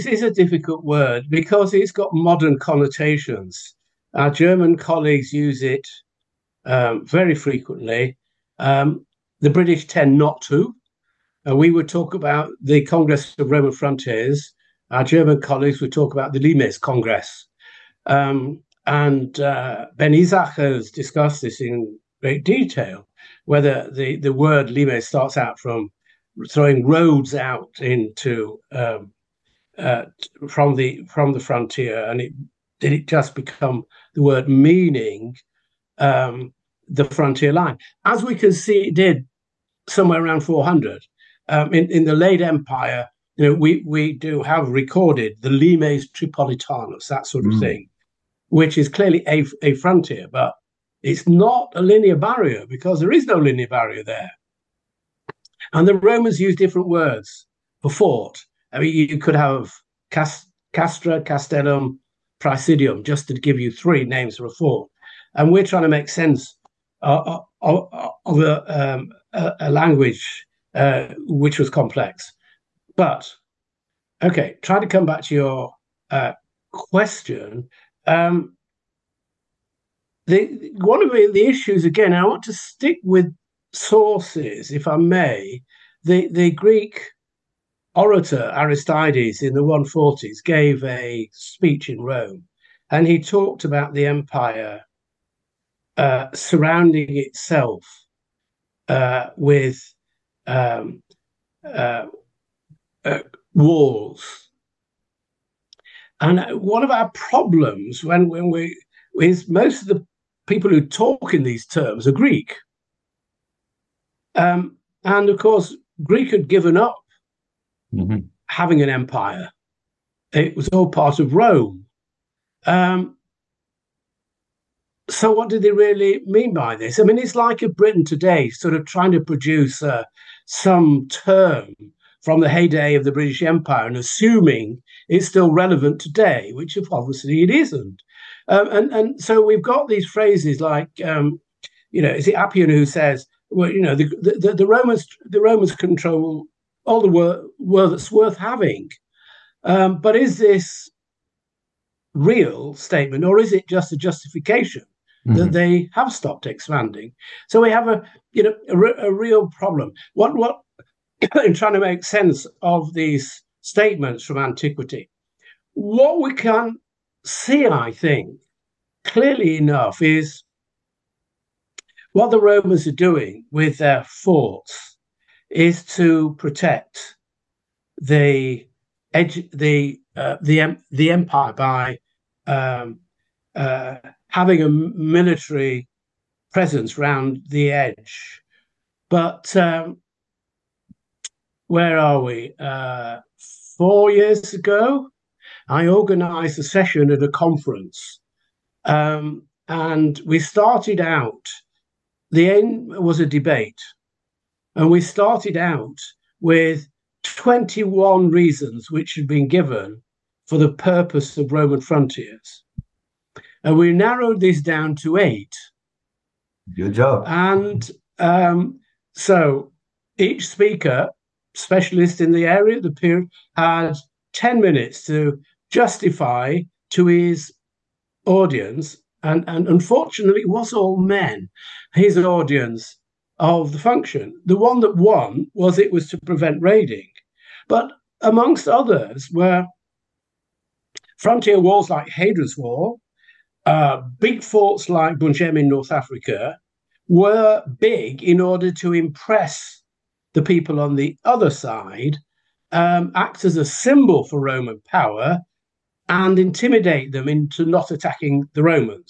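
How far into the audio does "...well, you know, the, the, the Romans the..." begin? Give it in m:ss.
2:23.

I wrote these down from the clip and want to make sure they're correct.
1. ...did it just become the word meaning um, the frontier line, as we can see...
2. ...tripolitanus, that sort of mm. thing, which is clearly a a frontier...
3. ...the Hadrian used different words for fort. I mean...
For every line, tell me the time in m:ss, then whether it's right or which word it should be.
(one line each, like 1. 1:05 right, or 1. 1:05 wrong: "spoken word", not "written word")
1. 0:32 right
2. 0:46 right
3. 0:55 wrong: "Romans", not "Hadrian".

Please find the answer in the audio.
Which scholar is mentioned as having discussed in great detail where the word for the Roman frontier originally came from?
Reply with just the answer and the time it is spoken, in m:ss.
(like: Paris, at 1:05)
Ben Isaac, at 0:19.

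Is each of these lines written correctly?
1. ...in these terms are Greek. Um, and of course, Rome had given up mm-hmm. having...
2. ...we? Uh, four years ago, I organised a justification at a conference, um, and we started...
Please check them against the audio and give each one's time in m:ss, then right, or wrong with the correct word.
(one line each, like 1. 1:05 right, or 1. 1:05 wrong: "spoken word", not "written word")
1. 1:51 wrong: "Greek", not "Rome"
2. 3:12 wrong: "session", not "justification".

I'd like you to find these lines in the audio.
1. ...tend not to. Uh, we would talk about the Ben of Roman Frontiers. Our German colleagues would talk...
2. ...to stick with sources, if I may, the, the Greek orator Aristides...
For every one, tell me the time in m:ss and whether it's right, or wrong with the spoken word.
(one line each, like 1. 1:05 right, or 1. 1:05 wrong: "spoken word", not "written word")
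1. 0:09 wrong: "Congress", not "Ben"
2. 1:22 right.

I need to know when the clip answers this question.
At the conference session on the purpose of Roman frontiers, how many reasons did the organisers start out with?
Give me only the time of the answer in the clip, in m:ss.
3:27.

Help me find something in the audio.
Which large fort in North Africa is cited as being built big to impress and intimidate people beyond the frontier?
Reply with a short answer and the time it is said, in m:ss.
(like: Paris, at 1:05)
Bu Njem, at 4:05.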